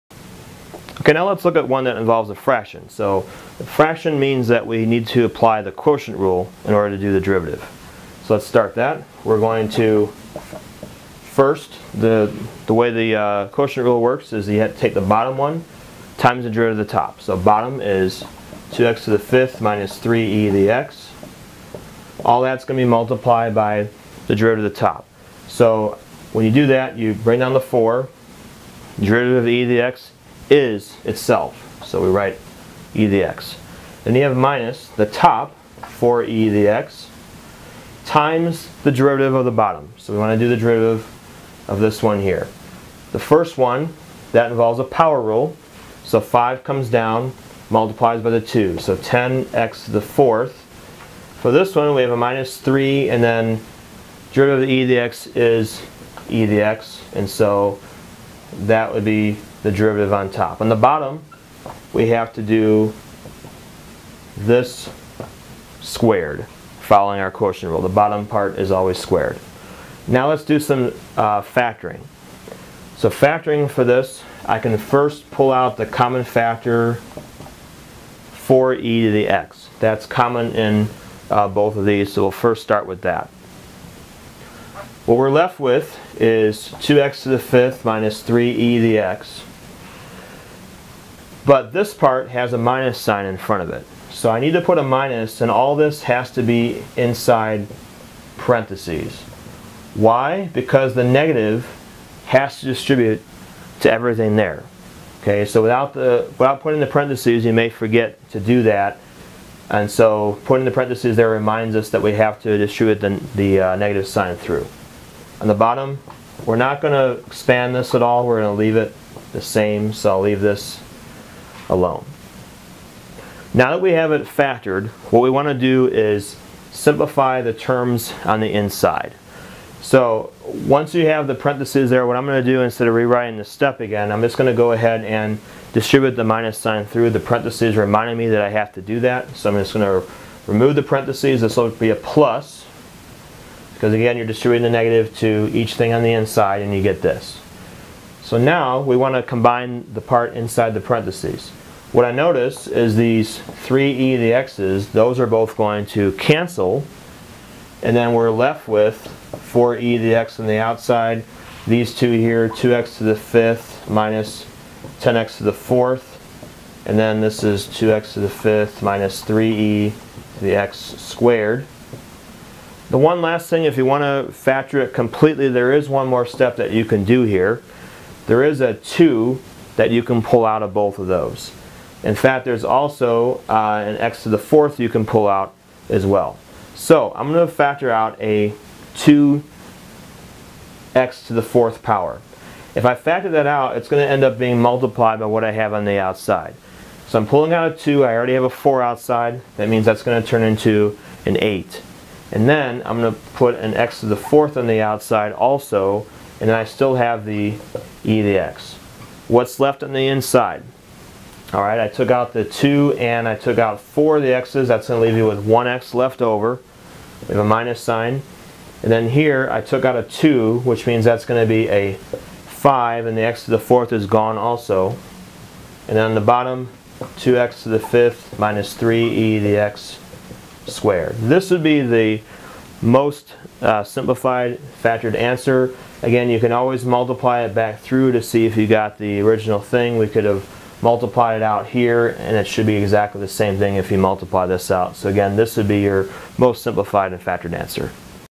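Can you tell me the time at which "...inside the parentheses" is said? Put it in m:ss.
2:30.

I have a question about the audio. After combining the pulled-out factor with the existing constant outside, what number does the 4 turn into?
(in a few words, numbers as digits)
8.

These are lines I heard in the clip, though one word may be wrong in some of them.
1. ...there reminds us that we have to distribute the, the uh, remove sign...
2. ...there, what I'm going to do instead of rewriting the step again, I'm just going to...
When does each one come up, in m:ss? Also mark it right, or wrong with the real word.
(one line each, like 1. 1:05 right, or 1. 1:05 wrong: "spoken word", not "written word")
1. 1:51 wrong: "negative", not "remove"
2. 2:11 right.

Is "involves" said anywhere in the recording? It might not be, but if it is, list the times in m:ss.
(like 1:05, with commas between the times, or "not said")
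0:01, 0:44.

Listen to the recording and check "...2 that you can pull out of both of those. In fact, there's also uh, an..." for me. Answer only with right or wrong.
right.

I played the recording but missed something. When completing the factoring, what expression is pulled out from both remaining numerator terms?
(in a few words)
2x^4.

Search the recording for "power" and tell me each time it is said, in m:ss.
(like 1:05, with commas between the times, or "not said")
0:44, 3:11.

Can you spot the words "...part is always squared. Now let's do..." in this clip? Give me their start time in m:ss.
1:08.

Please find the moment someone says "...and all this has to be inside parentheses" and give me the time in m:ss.
1:35.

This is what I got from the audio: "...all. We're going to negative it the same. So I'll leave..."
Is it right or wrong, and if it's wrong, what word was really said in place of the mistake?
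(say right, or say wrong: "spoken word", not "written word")
wrong: "leave", not "negative".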